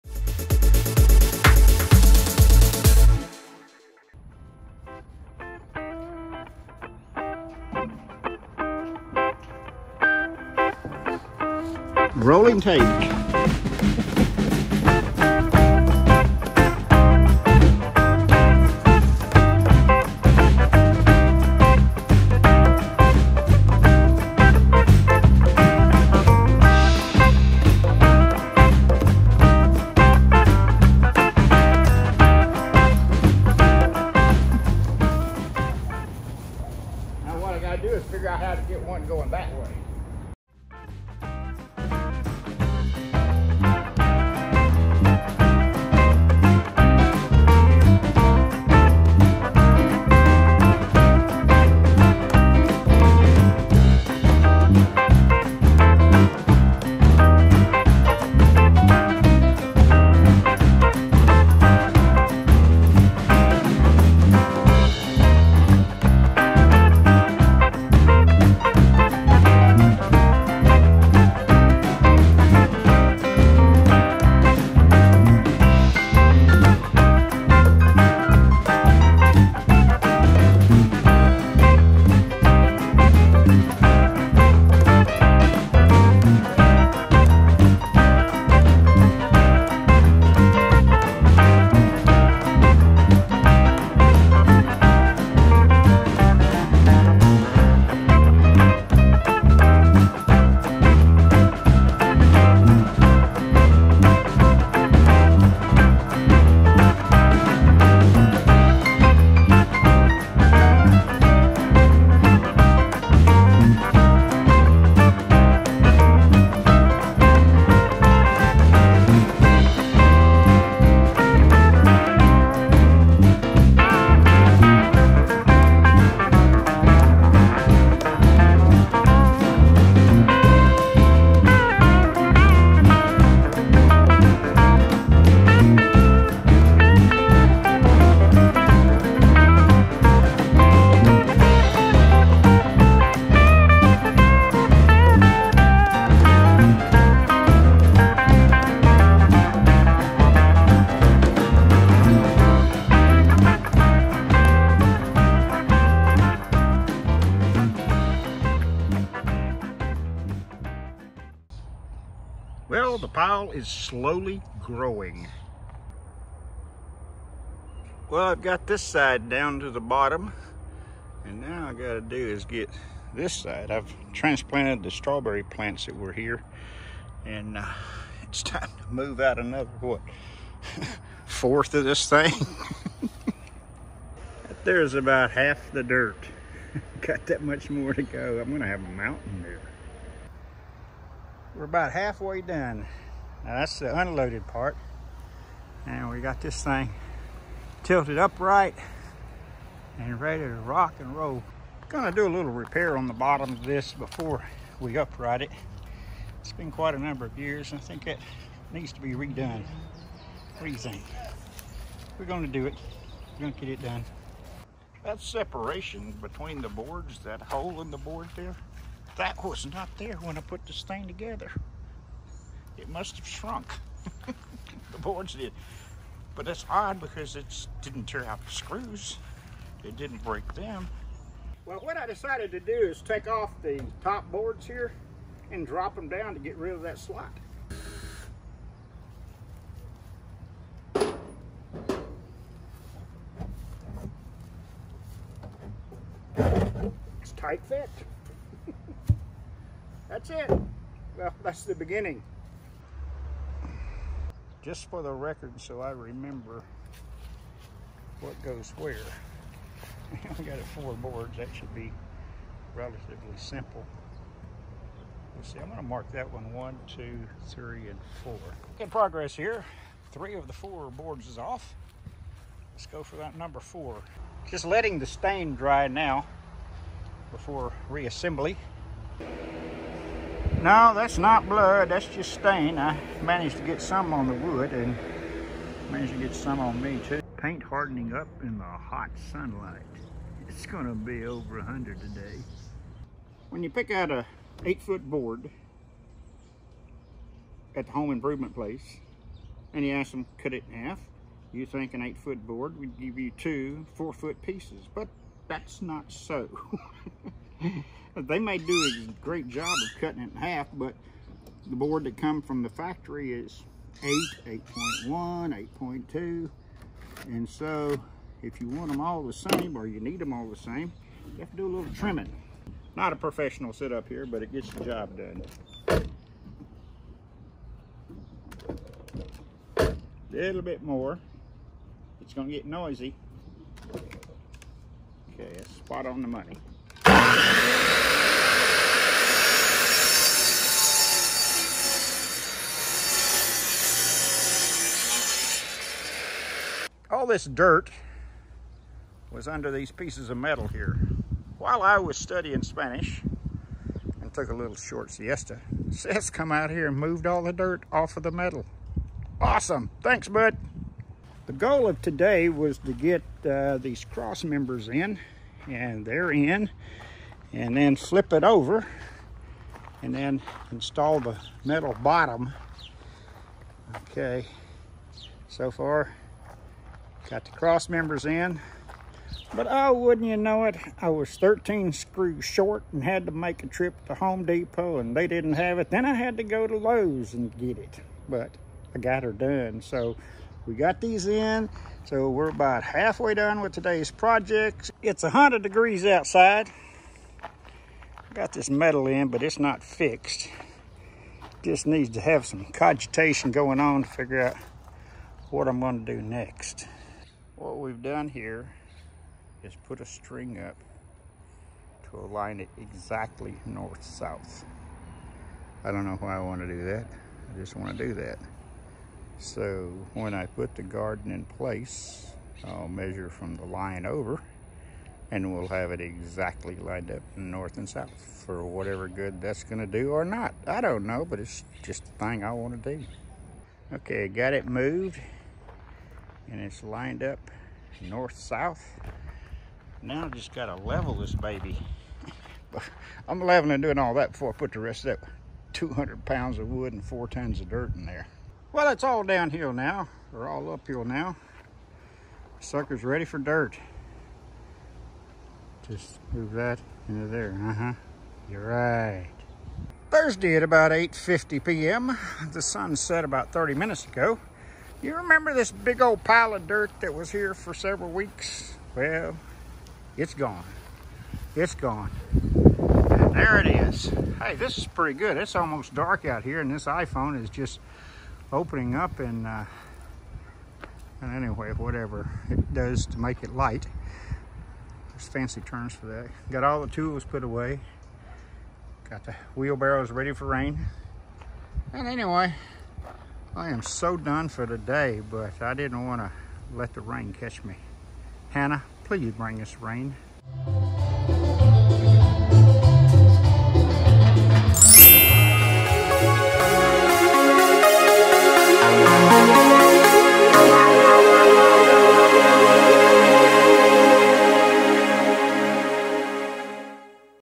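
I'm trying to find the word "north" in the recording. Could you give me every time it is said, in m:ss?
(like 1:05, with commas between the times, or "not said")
6:53, 7:07, 7:18.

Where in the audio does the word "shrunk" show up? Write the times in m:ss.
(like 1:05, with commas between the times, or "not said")
3:43.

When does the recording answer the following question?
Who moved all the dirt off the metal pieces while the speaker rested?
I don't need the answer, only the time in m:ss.
5:55.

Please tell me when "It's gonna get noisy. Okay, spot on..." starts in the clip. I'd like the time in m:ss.
5:32.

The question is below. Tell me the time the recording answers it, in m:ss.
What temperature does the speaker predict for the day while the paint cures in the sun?
4:51.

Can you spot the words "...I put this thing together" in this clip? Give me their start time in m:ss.
3:40.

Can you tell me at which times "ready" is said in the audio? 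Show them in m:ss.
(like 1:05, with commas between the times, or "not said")
3:20, 7:33, 8:10.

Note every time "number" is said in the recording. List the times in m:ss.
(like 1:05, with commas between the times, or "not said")
3:26, 4:33.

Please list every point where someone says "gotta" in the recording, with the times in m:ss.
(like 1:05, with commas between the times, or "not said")
0:37, 2:51, 7:20.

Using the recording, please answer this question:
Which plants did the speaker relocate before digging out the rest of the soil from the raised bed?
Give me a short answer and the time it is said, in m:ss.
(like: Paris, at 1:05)
strawberry plants, at 2:54.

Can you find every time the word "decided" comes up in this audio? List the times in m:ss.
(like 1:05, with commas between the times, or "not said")
3:52.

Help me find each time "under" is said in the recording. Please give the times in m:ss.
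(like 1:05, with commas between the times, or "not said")
5:49.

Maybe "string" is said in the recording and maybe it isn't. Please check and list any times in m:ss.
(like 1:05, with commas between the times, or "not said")
6:50.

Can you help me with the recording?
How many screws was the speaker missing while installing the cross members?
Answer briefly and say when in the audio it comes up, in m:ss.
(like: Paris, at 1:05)
13, at 6:21.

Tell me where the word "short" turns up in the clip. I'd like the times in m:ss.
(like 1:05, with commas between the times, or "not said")
5:54, 6:22.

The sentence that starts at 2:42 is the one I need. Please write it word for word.
Well, the pile is slowly growing.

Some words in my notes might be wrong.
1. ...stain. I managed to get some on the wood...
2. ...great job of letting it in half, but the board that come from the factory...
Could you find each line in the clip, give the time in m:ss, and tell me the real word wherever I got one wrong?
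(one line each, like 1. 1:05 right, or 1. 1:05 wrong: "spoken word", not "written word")
1. 4:42 right
2. 5:09 wrong: "cutting", not "letting".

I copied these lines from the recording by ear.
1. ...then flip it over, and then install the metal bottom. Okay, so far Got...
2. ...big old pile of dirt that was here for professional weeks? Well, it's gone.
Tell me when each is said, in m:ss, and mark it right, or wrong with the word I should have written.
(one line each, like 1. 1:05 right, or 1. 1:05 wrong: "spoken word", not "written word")
1. 6:07 right
2. 7:45 wrong: "several", not "professional".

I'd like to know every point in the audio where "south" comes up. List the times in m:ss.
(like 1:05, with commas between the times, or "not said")
6:53, 7:07, 7:18.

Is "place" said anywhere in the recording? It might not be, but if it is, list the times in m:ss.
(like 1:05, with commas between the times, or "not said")
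4:58, 7:01.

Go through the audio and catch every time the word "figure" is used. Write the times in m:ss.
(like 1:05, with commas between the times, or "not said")
0:38, 6:44.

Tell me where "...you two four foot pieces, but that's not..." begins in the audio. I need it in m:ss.
5:03.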